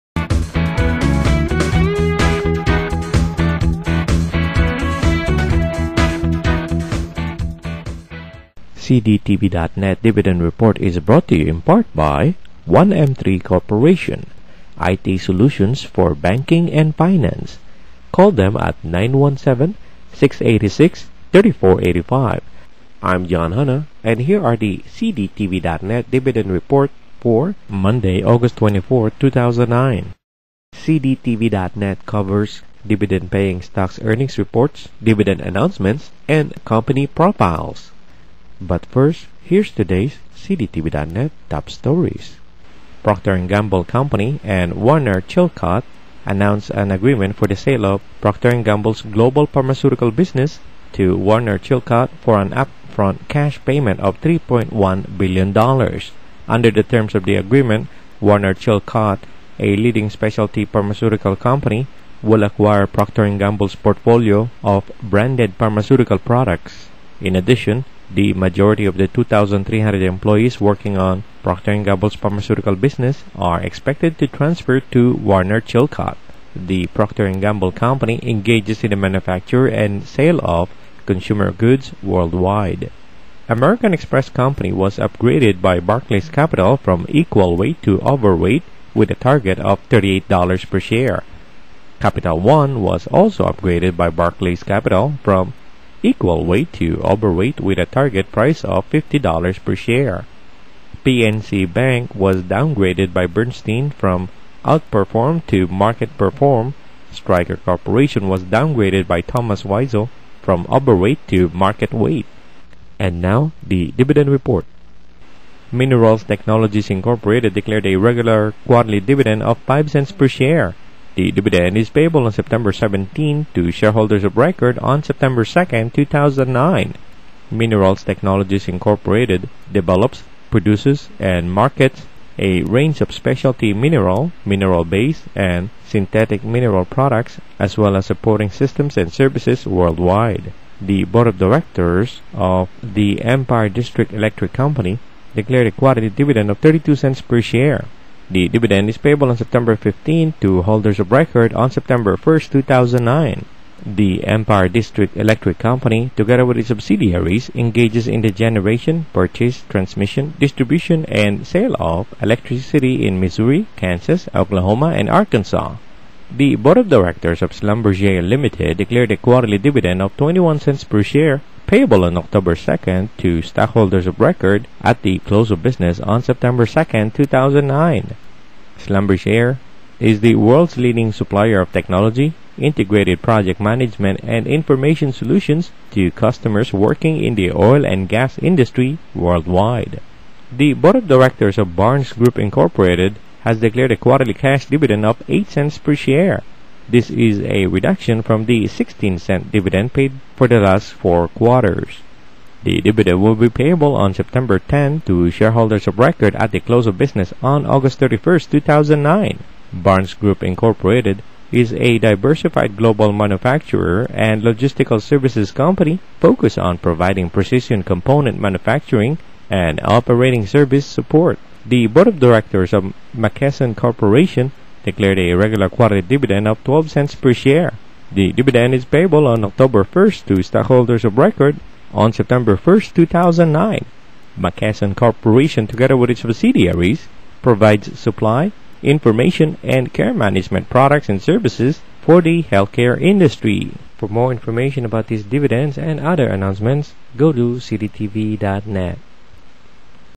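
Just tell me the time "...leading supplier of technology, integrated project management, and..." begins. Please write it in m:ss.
3:00.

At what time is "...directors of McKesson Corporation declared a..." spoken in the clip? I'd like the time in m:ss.
3:42.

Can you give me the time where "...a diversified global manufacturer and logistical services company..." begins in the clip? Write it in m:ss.
3:31.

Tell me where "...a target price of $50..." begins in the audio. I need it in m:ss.
1:37.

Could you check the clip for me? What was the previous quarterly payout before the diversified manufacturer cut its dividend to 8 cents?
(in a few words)
16 cents.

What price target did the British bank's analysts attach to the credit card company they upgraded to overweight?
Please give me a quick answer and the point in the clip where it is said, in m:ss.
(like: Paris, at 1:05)
$38 per share, at 1:29.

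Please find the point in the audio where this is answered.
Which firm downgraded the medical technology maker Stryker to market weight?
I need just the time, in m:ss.
1:49.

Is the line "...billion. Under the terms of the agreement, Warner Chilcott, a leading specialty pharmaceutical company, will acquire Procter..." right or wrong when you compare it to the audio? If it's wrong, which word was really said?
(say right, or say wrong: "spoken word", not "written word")
right.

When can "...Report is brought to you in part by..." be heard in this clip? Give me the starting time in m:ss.
0:10.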